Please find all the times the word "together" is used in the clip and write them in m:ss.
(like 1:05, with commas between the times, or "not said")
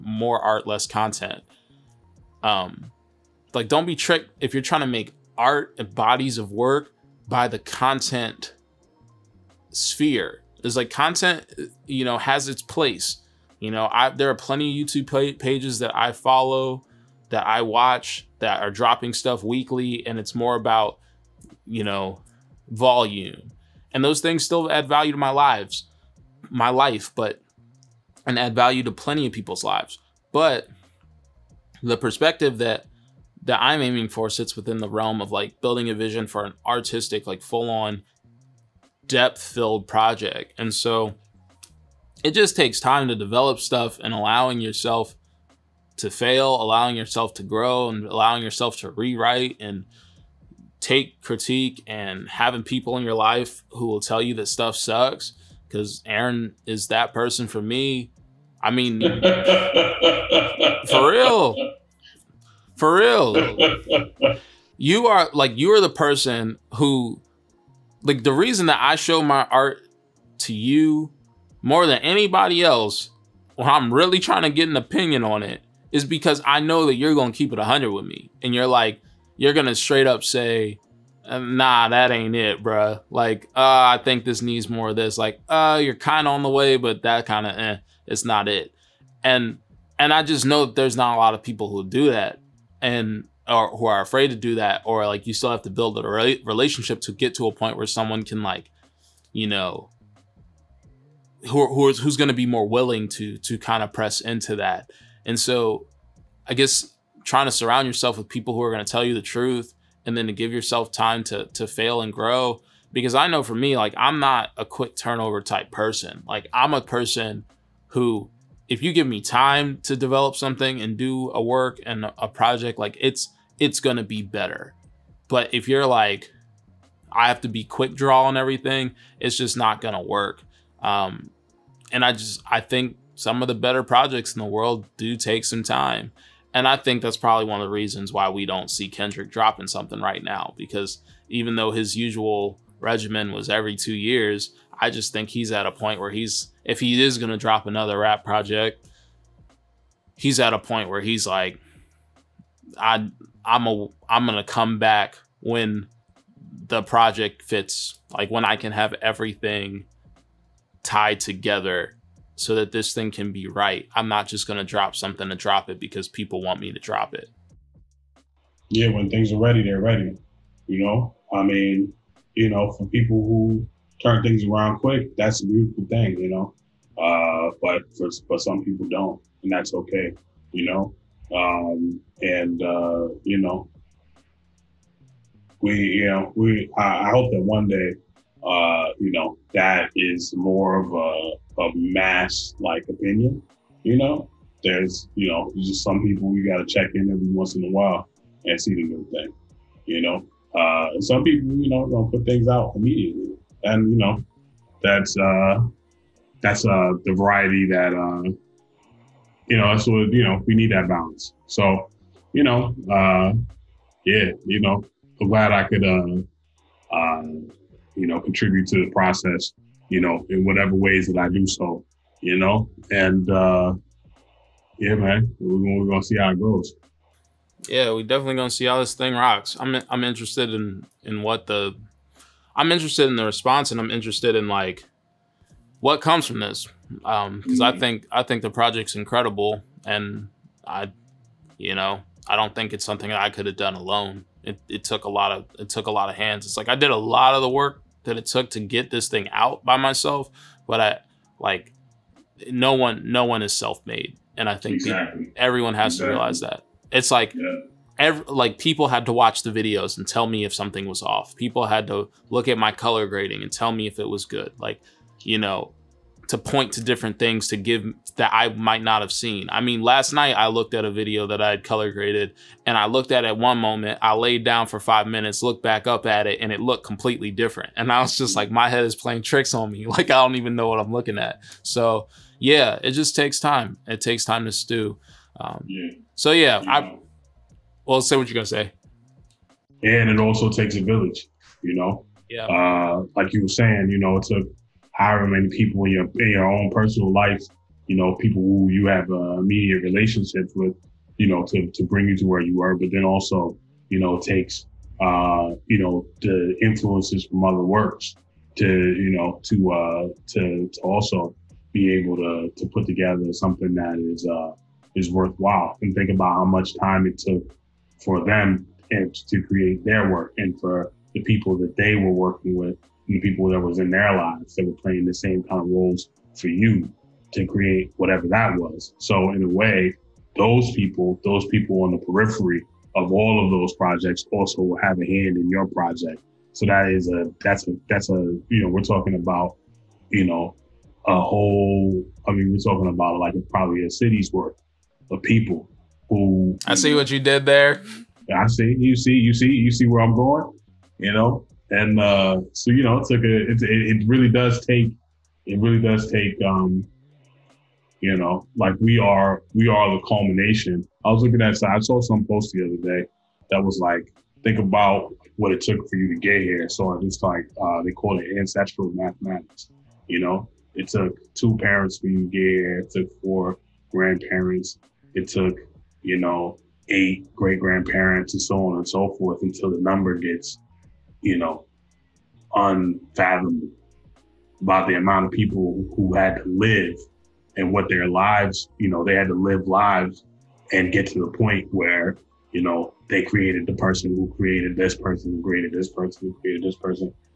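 2:41, 5:12.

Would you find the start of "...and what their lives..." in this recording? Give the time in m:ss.
6:27.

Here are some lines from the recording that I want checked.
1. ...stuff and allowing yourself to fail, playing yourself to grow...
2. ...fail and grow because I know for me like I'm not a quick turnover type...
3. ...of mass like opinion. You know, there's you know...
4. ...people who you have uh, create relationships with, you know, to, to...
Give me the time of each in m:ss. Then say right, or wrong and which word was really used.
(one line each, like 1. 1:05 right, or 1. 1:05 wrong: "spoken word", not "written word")
1. 0:43 wrong: "allowing", not "playing"
2. 1:51 right
3. 3:11 right
4. 4:58 wrong: "immediate", not "create".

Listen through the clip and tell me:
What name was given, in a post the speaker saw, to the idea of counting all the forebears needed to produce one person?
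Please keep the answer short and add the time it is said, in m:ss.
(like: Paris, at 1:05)
ancestral mathematics, at 6:08.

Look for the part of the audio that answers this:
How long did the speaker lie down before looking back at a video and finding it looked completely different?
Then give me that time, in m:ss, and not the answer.
4:34.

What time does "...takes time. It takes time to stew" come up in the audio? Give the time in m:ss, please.
4:43.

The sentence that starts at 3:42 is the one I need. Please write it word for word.
And uh, yeah, man, we're, we're going to see how it goes.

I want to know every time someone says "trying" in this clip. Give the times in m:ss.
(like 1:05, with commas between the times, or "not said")
0:04, 1:14, 1:47.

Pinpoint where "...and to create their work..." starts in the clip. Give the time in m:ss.
5:18.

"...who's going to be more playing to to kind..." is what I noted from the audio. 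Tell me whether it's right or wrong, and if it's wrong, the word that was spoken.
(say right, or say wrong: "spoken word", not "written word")
wrong: "willing", not "playing".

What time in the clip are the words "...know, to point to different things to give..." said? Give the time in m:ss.
4:25.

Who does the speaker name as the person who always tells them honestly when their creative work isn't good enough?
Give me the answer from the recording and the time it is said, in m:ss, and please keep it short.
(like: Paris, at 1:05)
Aaron, at 0:56.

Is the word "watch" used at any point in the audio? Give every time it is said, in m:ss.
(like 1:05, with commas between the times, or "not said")
0:17, 4:19.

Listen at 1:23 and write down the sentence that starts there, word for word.
Like, uh, I think this needs more of this.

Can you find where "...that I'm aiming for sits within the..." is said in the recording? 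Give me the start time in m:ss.
0:33.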